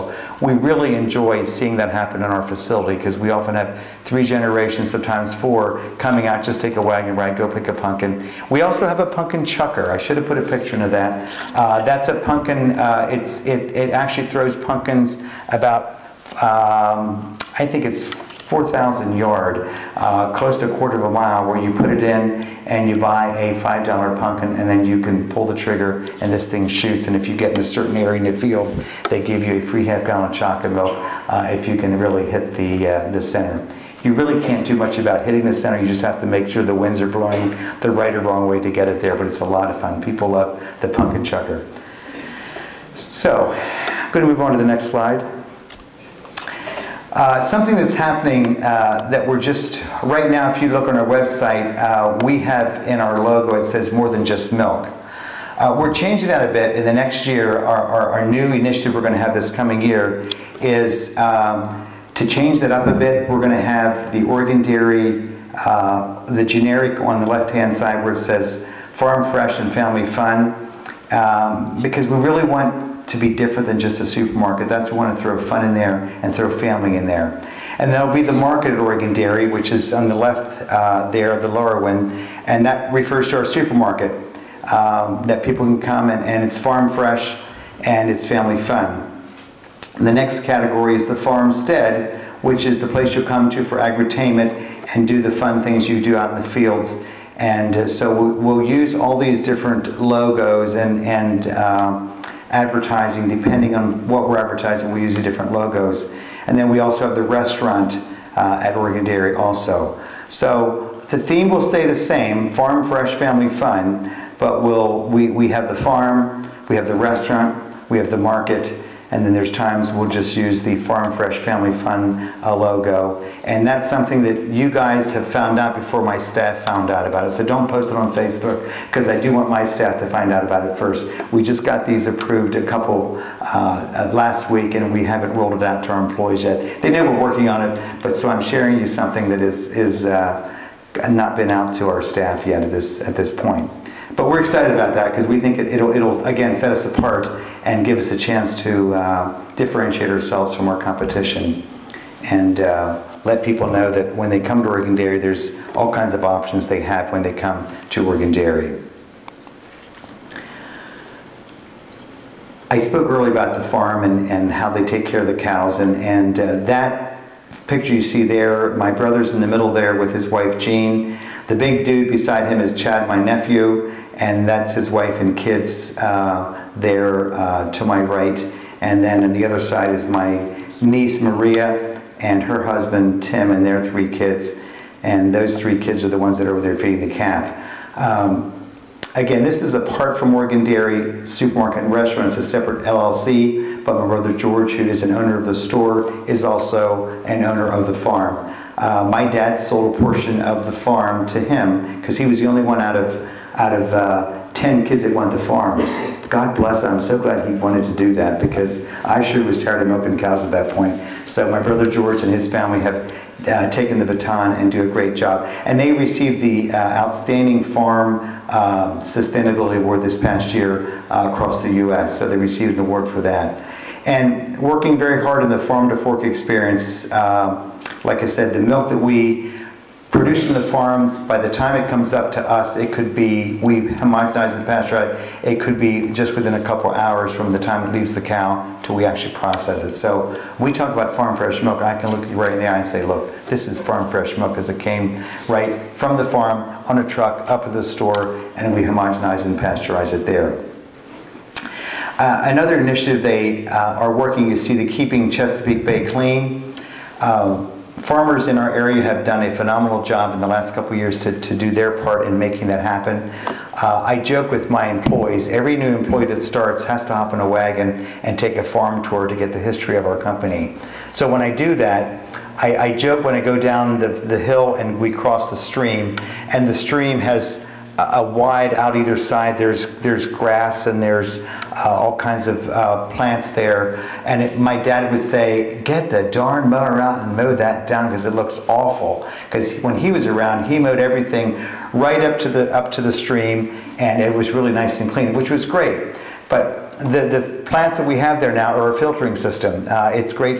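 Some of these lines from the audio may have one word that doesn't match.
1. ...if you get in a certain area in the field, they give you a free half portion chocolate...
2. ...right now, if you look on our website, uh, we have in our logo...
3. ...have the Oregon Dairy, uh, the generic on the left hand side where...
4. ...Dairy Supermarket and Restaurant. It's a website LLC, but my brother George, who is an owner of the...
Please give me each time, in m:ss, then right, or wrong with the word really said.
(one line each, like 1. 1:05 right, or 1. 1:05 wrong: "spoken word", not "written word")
1. 0:27 wrong: "gallon", not "portion"
2. 0:50 right
3. 1:03 right
4. 3:10 wrong: "separate", not "website".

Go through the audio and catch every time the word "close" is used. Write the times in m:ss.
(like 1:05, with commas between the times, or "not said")
0:20.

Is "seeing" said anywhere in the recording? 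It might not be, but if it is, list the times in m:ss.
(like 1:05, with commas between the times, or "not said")
0:01.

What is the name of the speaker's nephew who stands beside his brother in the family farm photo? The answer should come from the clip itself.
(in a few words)
Chad.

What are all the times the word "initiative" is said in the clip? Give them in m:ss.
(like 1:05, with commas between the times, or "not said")
0:58, 4:12.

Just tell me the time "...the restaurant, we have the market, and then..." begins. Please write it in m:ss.
1:56.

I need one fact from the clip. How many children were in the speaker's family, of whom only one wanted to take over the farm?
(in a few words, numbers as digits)
10.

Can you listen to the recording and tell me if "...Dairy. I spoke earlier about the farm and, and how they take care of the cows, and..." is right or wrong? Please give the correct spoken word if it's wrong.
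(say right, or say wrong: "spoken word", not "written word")
right.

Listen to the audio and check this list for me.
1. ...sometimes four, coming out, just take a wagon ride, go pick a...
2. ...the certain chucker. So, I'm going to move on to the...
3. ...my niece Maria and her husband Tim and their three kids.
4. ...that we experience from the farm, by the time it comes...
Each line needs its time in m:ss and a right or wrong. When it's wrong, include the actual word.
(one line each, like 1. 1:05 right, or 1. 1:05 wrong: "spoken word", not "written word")
1. 0:04 right
2. 0:40 wrong: "pumpkin", not "certain"
3. 3:00 right
4. 3:48 wrong: "produce", not "experience".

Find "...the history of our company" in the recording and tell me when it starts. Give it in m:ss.
4:29.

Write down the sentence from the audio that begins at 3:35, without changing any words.
And they received the uh, Outstanding Farm um, Sustainability Award this past year uh, across the U.S.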